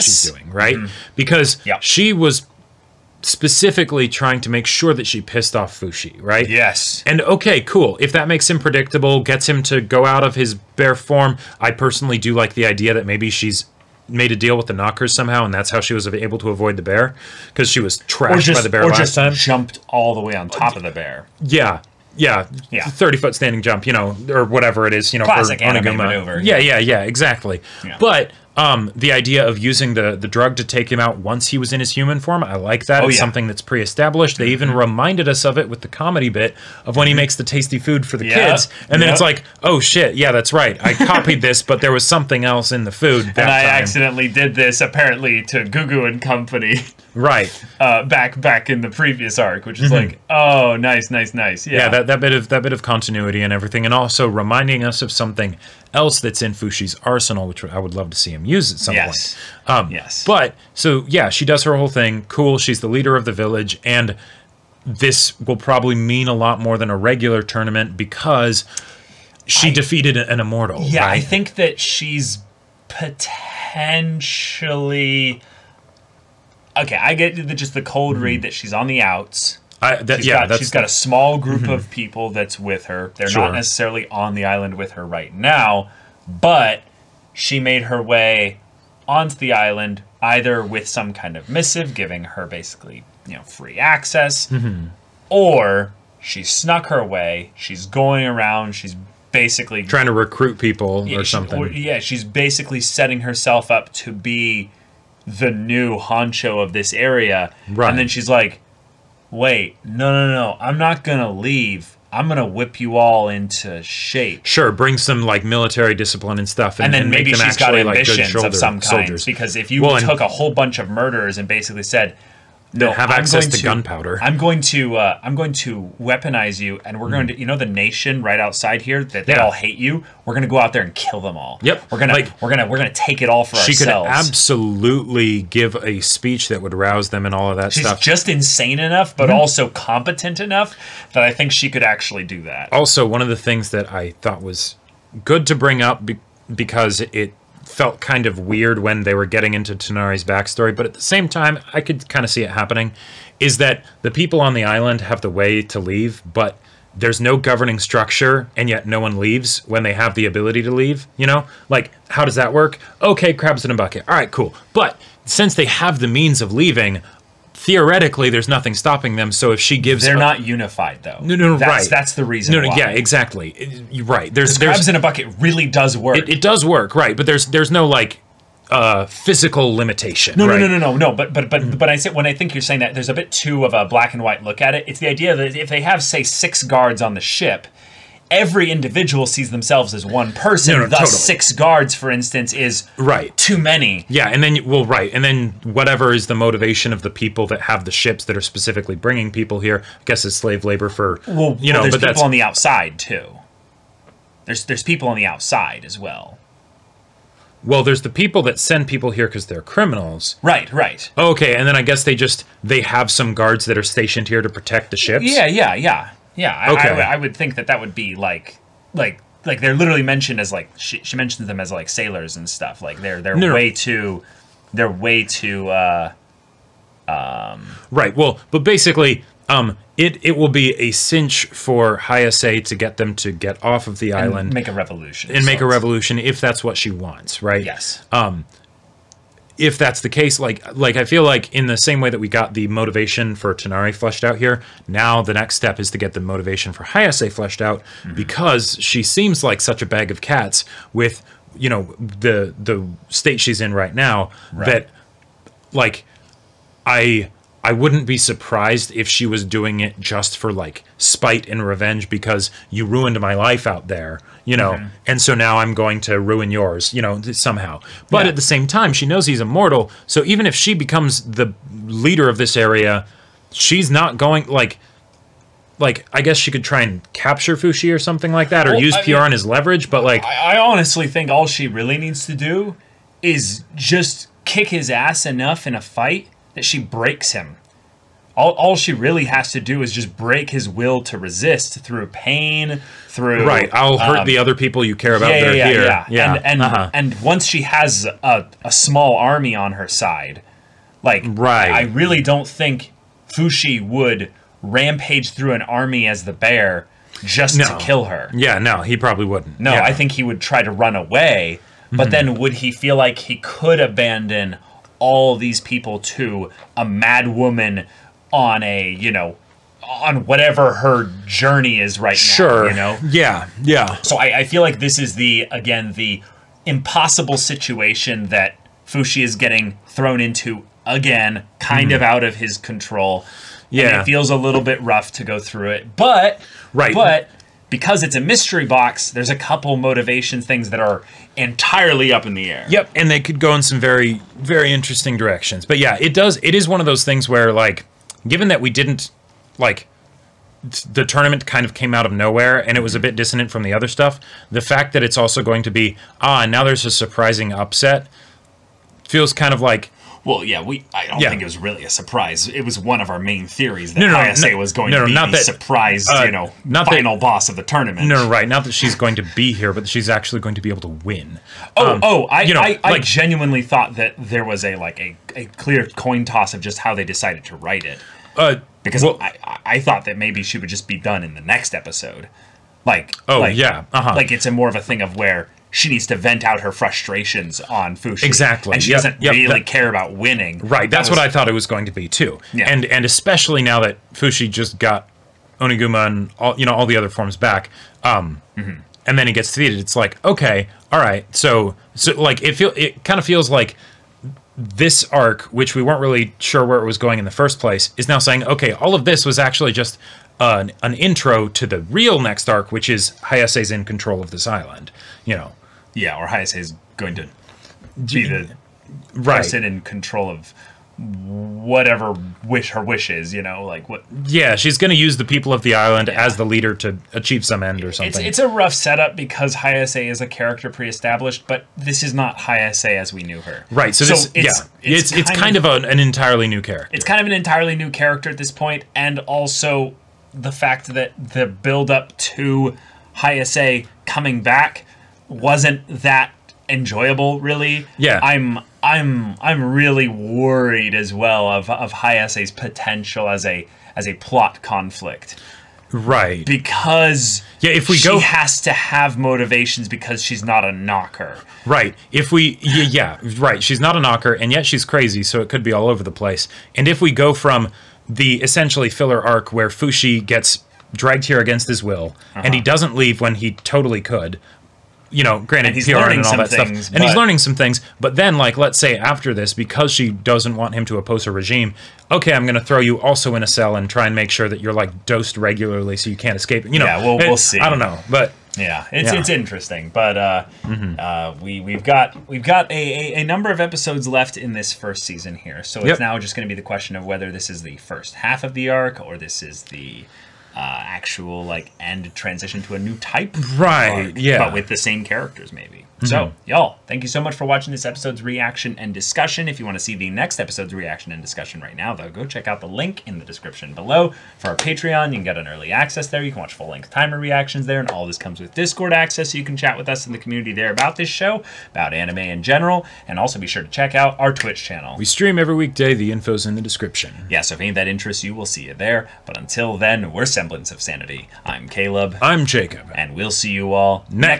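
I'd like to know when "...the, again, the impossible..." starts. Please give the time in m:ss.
5:25.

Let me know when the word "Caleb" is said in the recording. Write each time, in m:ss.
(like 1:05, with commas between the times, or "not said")
8:51.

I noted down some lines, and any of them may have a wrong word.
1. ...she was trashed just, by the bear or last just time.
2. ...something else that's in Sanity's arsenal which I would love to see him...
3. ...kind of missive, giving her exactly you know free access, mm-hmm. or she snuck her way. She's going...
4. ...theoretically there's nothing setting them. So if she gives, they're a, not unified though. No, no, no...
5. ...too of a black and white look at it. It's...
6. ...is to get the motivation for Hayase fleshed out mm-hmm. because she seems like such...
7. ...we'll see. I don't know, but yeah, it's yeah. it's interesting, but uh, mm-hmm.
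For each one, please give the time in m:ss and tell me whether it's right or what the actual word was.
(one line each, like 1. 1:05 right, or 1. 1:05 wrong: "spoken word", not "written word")
1. 0:17 right
2. 0:55 wrong: "Fushi", not "Sanity"
3. 1:31 wrong: "basically", not "exactly"
4. 2:47 wrong: "stopping", not "setting"
5. 3:03 right
6. 4:05 right
7. 8:07 right.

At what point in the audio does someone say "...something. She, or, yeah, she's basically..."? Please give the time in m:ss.
1:41.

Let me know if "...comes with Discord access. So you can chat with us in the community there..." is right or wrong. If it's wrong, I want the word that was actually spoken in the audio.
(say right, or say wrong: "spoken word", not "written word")
right.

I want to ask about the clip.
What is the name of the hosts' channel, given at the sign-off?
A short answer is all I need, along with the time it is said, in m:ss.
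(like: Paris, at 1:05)
Semblance of Sanity, at 8:50.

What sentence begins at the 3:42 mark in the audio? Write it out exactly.
Like they're they're no, way no.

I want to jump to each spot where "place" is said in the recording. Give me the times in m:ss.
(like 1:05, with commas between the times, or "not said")
6:47, 7:46.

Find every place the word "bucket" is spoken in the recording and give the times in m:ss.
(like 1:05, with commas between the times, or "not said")
2:43, 2:54.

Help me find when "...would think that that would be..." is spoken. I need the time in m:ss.
3:37.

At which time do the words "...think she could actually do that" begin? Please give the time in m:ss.
2:21.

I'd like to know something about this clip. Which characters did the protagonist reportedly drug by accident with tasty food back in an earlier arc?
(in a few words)
Gugu and Company.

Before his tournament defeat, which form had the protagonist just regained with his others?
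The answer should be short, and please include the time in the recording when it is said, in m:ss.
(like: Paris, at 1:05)
Oniguma, at 6:35.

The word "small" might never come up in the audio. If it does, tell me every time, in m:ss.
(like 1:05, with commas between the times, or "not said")
1:20, 4:58.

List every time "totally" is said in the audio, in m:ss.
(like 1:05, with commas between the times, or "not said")
3:10, 7:53.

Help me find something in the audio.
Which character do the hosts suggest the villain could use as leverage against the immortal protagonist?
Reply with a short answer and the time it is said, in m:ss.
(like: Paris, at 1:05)
Pioran, at 4:38.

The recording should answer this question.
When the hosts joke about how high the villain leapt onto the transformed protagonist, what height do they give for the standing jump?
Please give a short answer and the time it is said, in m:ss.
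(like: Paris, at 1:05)
30 feet, at 0:22.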